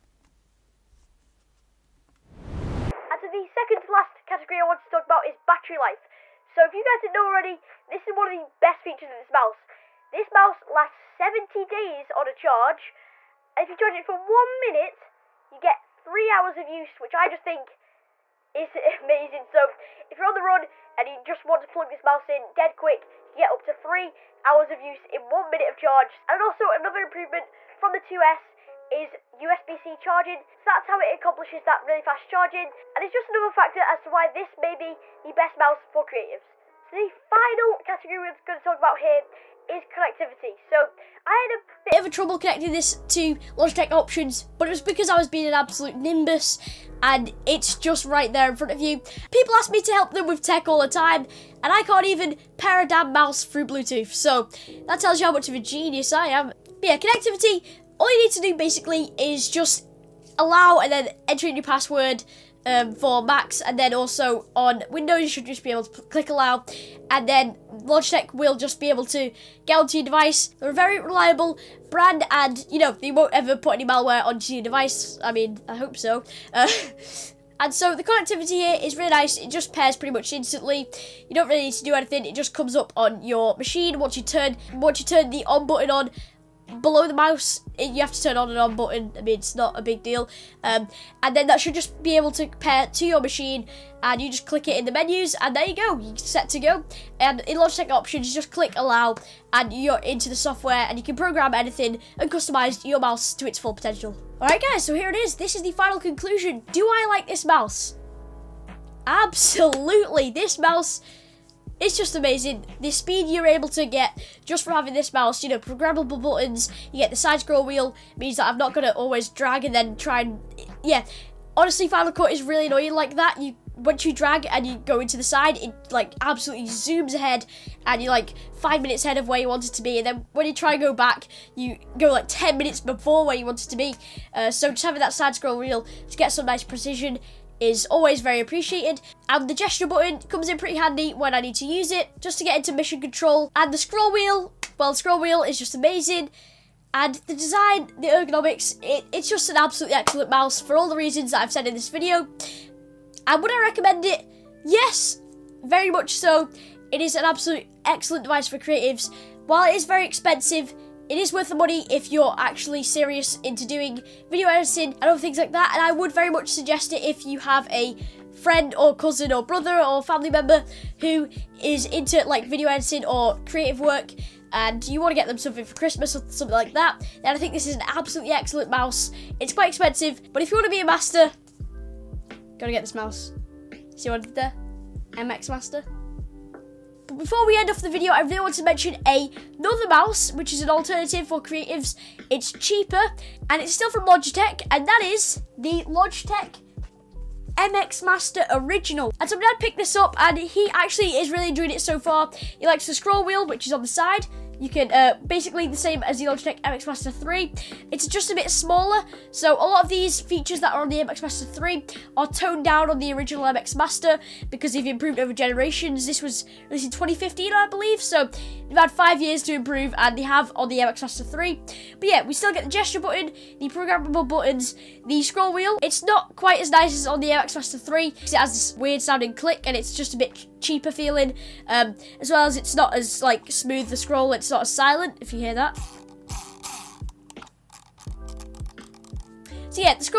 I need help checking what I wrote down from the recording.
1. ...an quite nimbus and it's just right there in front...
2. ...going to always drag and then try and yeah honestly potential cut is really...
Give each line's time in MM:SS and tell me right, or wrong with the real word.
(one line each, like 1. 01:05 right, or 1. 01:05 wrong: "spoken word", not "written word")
1. 00:45 wrong: "absolute", not "quite"
2. 01:58 wrong: "final", not "potential".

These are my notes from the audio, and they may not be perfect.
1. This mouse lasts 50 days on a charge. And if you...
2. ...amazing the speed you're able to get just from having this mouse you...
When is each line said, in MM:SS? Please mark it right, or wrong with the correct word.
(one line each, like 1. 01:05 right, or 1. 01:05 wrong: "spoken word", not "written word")
1. 00:10 wrong: "70", not "50"
2. 01:52 right.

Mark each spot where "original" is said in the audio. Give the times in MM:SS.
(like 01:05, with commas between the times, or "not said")
03:18, 03:33.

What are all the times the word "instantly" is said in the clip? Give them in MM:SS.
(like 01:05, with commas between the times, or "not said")
01:20.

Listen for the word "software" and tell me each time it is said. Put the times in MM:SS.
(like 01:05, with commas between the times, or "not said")
01:40.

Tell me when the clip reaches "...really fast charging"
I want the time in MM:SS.
00:31.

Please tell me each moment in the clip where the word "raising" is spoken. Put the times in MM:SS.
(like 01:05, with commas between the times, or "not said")
not said.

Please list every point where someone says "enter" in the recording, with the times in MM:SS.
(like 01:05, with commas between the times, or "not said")
01:01.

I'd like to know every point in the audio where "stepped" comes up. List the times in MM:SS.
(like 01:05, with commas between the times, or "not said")
not said.